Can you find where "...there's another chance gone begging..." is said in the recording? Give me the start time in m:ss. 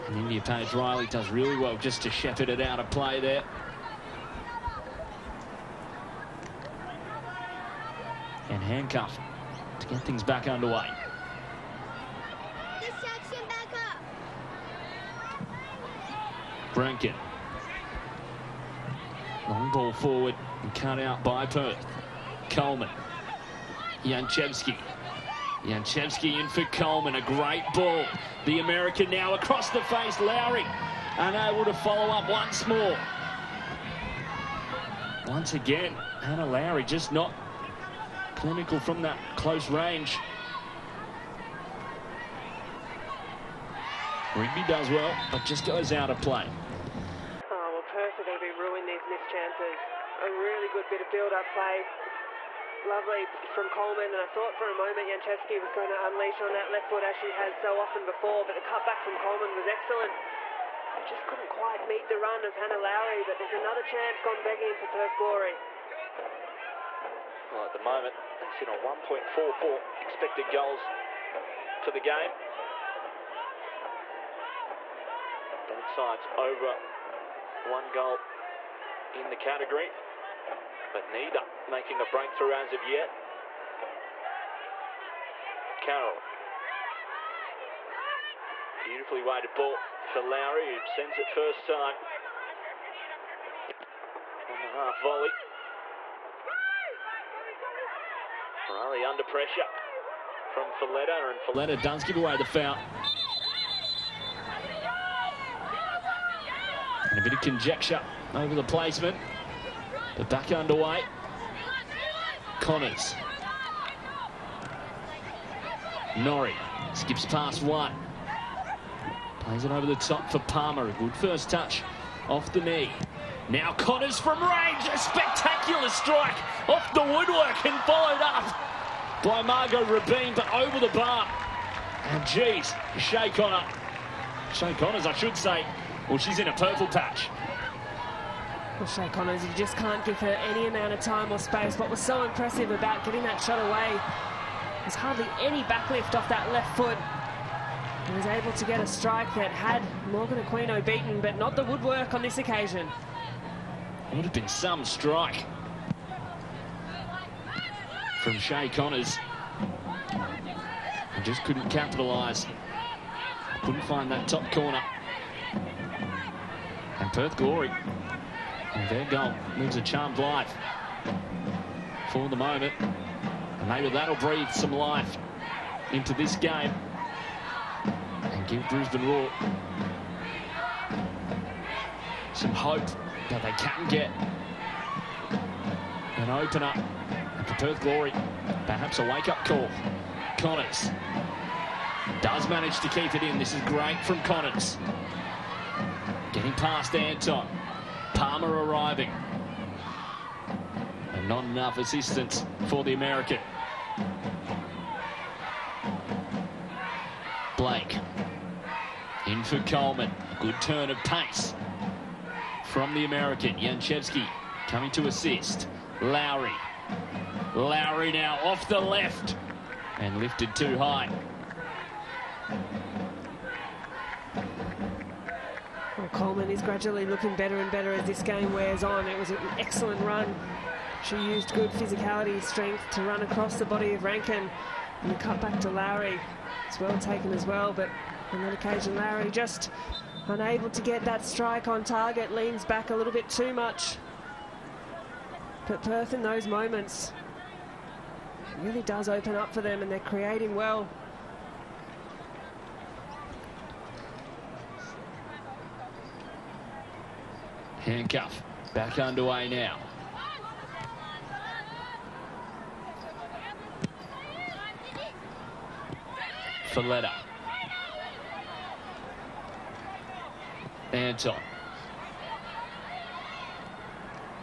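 1:03.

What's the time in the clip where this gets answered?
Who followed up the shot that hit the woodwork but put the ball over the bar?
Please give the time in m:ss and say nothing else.
2:09.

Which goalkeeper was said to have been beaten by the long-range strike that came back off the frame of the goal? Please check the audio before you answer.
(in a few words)
Morgan Aquino.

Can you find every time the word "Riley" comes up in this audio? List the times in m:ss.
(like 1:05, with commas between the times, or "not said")
0:00, 1:38.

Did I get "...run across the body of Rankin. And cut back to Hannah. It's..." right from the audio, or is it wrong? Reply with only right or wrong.
wrong.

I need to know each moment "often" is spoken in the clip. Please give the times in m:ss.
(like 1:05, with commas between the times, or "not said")
0:57.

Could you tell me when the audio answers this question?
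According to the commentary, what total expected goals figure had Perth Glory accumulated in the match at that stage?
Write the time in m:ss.
1:09.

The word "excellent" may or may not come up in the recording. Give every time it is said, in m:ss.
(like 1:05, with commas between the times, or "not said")
0:59, 3:49.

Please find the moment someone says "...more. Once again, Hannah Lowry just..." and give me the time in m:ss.
0:32.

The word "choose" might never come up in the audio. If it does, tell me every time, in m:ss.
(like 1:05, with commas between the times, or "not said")
not said.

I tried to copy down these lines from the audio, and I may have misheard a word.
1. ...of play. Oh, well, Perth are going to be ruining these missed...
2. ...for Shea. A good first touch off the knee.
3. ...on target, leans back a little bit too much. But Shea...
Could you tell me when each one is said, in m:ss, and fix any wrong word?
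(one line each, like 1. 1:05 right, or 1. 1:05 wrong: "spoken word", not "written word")
1. 0:46 right
2. 2:00 wrong: "Palmer", not "Shea"
3. 4:01 wrong: "Perth", not "Shea".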